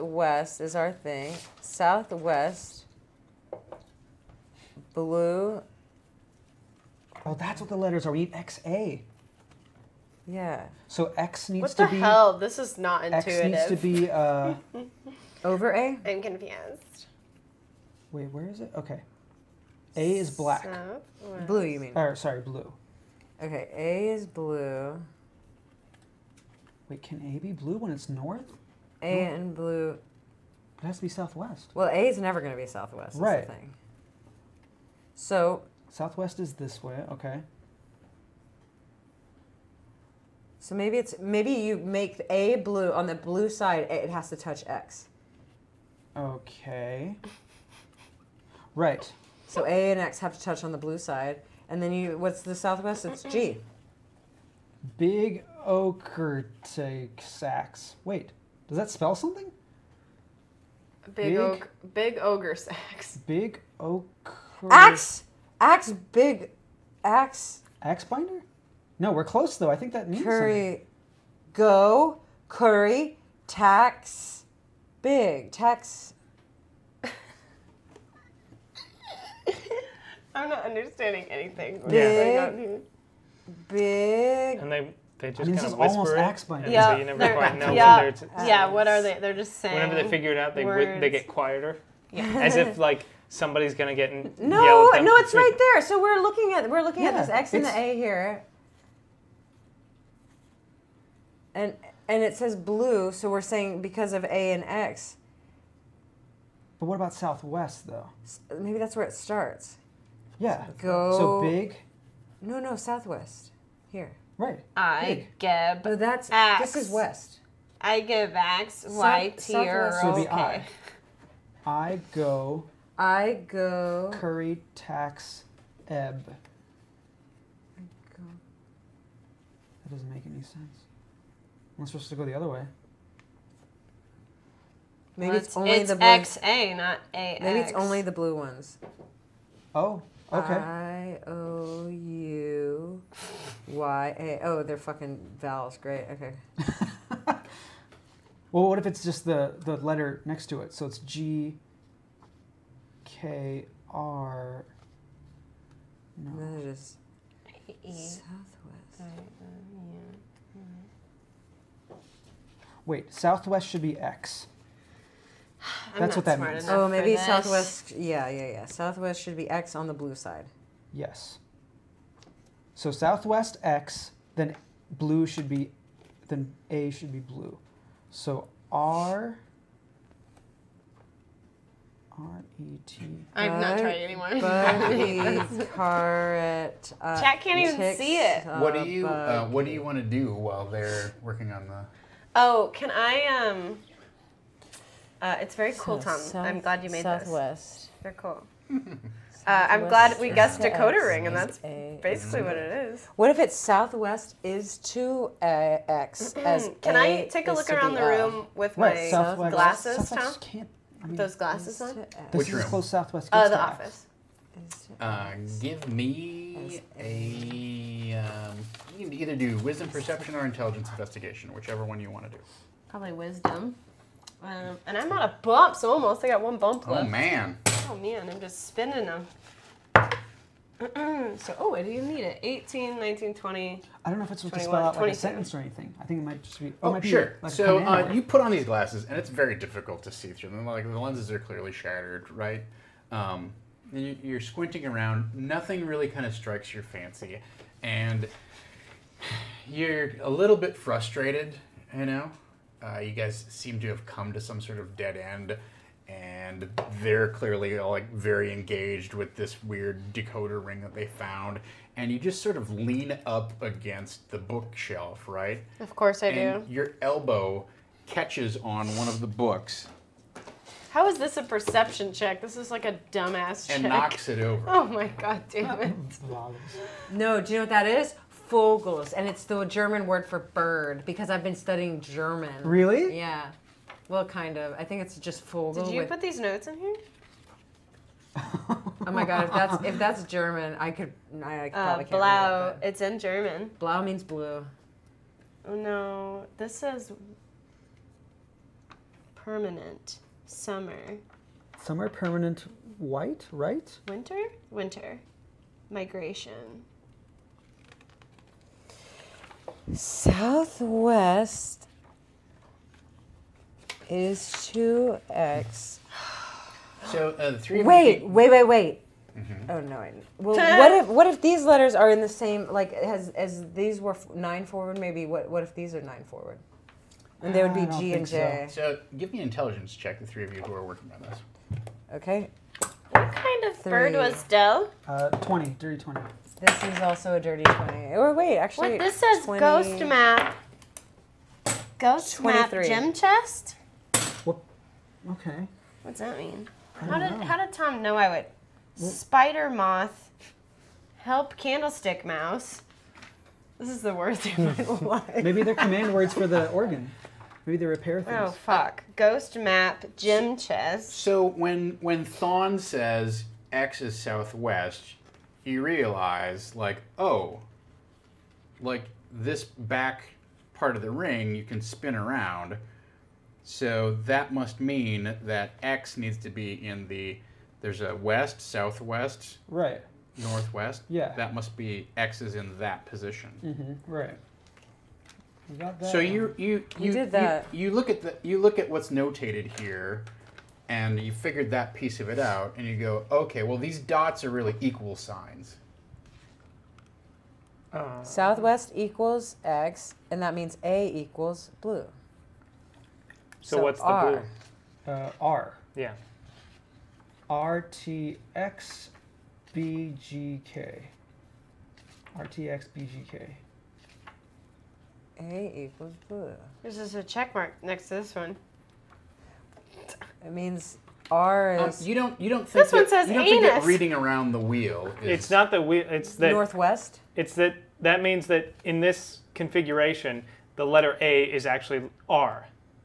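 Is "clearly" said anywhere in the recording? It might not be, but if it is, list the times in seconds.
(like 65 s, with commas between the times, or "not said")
241 s, 257 s.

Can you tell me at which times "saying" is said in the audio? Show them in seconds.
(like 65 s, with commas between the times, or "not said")
89 s, 103 s.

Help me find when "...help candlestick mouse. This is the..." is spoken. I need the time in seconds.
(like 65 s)
351 s.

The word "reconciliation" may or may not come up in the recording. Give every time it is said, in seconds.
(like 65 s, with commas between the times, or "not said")
not said.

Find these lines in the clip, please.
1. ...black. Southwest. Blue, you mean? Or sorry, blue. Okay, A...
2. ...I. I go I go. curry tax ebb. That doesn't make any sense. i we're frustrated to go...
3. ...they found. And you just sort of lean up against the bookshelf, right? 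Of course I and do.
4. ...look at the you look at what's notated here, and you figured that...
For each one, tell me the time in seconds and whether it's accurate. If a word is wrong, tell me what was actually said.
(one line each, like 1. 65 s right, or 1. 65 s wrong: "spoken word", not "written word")
1. 20 s right
2. 120 s wrong: "supposed", not "frustrated"
3. 260 s right
4. 387 s right.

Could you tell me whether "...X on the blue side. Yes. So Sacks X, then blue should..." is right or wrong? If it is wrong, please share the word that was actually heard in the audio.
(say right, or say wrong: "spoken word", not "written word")
wrong: "Southwest", not "Sacks".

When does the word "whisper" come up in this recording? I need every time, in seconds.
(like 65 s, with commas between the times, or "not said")
85 s.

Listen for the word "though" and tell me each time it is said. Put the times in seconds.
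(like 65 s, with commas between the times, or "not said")
69 s, 107 s.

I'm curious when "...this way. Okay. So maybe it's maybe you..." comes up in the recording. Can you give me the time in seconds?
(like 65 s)
36 s.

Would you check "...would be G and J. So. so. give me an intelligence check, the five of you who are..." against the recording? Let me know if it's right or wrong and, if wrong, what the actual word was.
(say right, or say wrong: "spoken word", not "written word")
wrong: "three", not "five".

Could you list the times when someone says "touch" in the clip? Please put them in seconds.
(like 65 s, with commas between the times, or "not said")
44 s, 50 s.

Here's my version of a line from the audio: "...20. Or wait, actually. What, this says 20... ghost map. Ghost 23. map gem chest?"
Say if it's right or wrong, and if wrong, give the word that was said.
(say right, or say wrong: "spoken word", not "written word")
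right.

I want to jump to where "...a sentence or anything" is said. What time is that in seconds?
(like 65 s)
235 s.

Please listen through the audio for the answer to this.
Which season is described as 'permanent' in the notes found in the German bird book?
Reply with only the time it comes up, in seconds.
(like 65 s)
296 s.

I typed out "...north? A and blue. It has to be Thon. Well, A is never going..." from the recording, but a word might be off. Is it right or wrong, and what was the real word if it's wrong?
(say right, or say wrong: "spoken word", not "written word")
wrong: "Southwest", not "Thon".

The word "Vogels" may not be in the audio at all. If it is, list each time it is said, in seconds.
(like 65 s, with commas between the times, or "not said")
278 s, 285 s.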